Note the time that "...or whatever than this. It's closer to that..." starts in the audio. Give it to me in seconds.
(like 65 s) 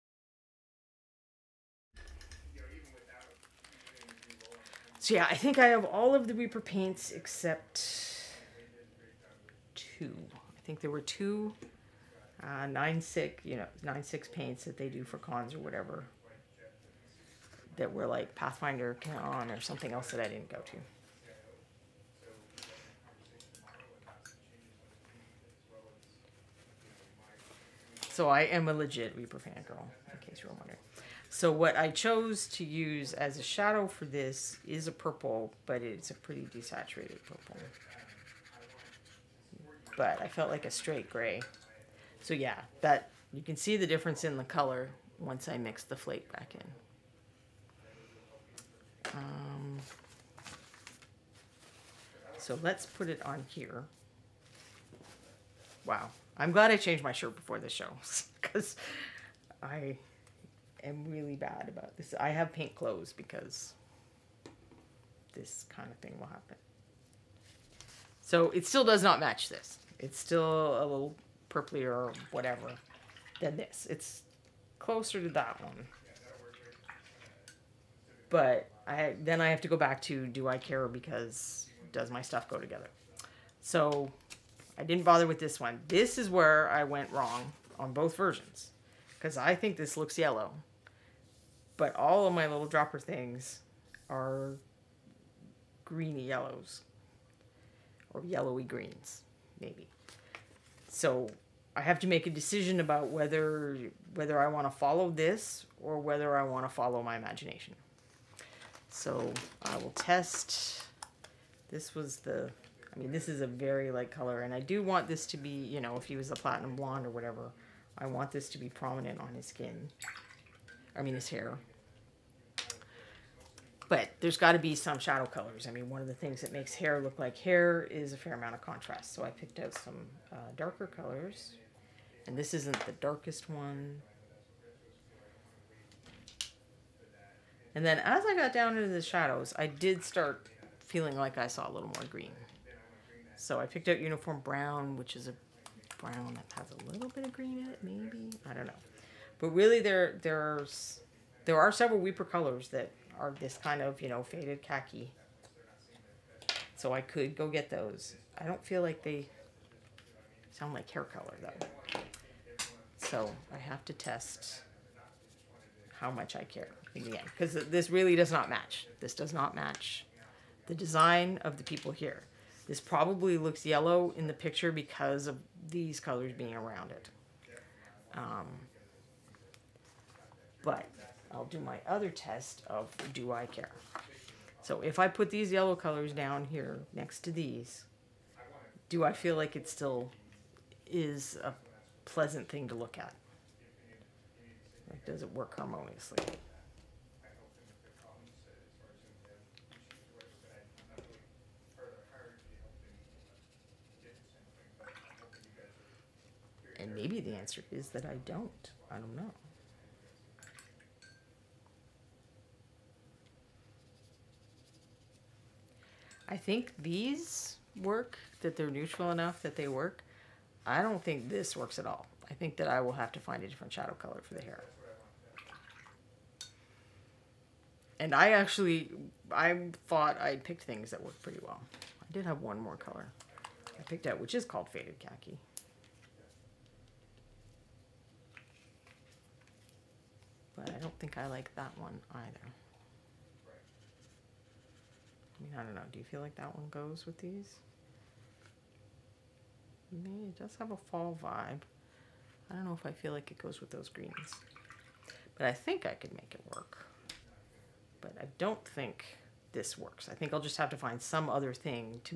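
71 s.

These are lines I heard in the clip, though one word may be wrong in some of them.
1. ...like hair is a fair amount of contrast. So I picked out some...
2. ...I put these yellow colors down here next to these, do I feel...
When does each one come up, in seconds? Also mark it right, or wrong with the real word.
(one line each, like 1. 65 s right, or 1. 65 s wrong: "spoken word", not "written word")
1. 127 s right
2. 184 s right.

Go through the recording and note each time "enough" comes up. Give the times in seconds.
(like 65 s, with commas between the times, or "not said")
219 s.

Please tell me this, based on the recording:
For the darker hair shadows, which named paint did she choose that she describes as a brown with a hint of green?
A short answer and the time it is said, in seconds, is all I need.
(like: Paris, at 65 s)
Uniform Brown, at 143 s.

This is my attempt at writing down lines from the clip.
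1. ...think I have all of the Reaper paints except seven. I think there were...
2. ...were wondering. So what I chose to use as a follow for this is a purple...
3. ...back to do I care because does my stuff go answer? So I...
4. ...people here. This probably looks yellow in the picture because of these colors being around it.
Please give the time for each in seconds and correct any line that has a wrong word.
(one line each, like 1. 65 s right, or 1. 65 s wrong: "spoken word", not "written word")
1. 5 s wrong: "two", not "seven"
2. 30 s wrong: "shadow", not "follow"
3. 79 s wrong: "together", not "answer"
4. 171 s right.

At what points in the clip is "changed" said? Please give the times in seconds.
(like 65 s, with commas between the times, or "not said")
56 s.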